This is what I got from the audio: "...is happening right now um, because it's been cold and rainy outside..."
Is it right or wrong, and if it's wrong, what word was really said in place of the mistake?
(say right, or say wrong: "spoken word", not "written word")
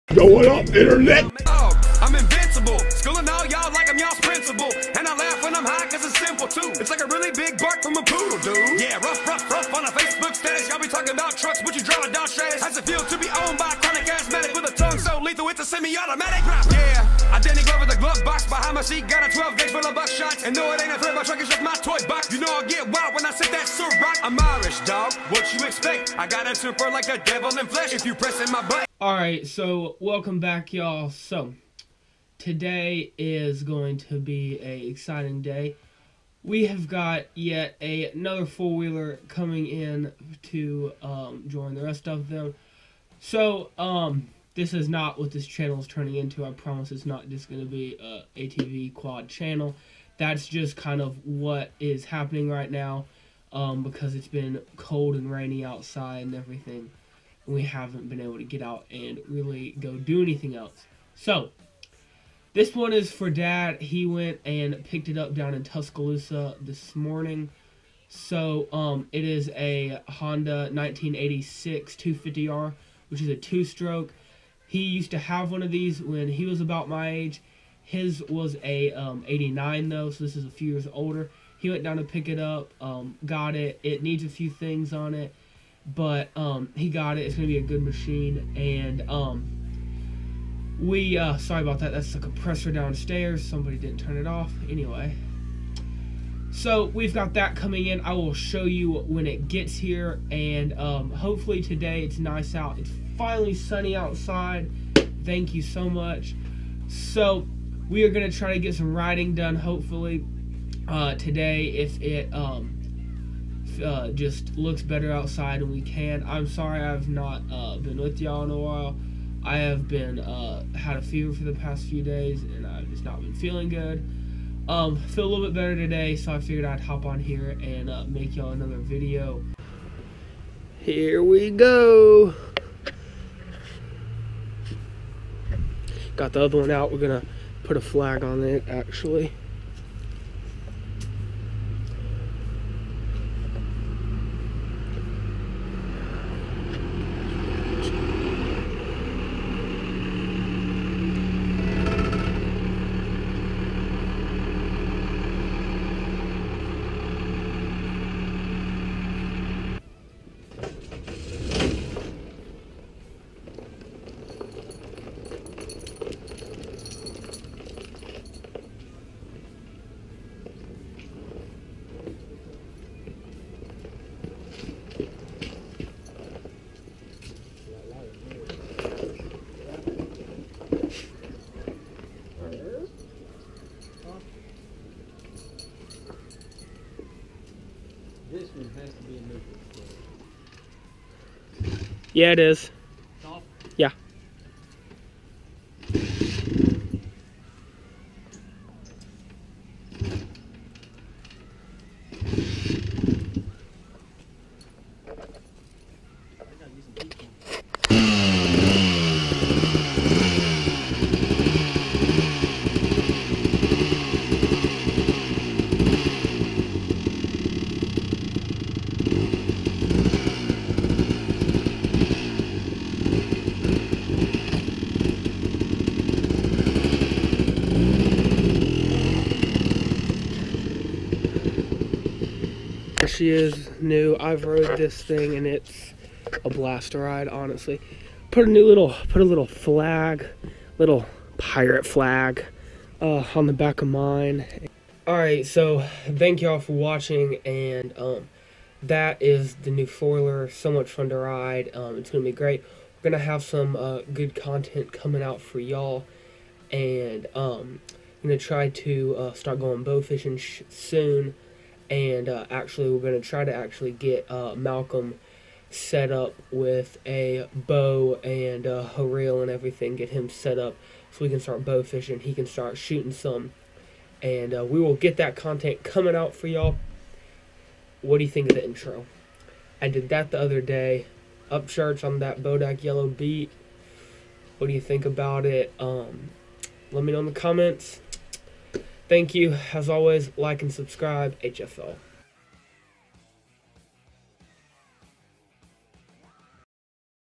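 right.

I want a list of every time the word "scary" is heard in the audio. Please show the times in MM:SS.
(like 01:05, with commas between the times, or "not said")
not said.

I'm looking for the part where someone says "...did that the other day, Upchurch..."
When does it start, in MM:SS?
04:39.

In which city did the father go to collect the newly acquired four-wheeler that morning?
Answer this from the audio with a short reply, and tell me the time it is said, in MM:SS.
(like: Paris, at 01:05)
Tuscaloosa, at 01:05.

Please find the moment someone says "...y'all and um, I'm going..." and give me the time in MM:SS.
04:15.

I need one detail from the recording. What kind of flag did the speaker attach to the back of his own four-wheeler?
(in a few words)
Pirate flag.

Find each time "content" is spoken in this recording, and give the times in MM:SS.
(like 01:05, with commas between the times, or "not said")
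04:14, 04:35.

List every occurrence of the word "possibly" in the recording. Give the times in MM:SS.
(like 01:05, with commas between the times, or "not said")
not said.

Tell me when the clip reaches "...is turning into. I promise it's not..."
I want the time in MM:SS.
00:45.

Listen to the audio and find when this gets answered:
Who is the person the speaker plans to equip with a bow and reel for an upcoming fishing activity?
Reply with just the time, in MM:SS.
04:24.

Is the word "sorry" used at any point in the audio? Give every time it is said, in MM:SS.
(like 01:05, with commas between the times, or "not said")
01:31, 01:56.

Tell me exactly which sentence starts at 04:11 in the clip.
Um, it's going to be great.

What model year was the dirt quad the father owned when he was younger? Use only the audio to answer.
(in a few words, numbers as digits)
1989.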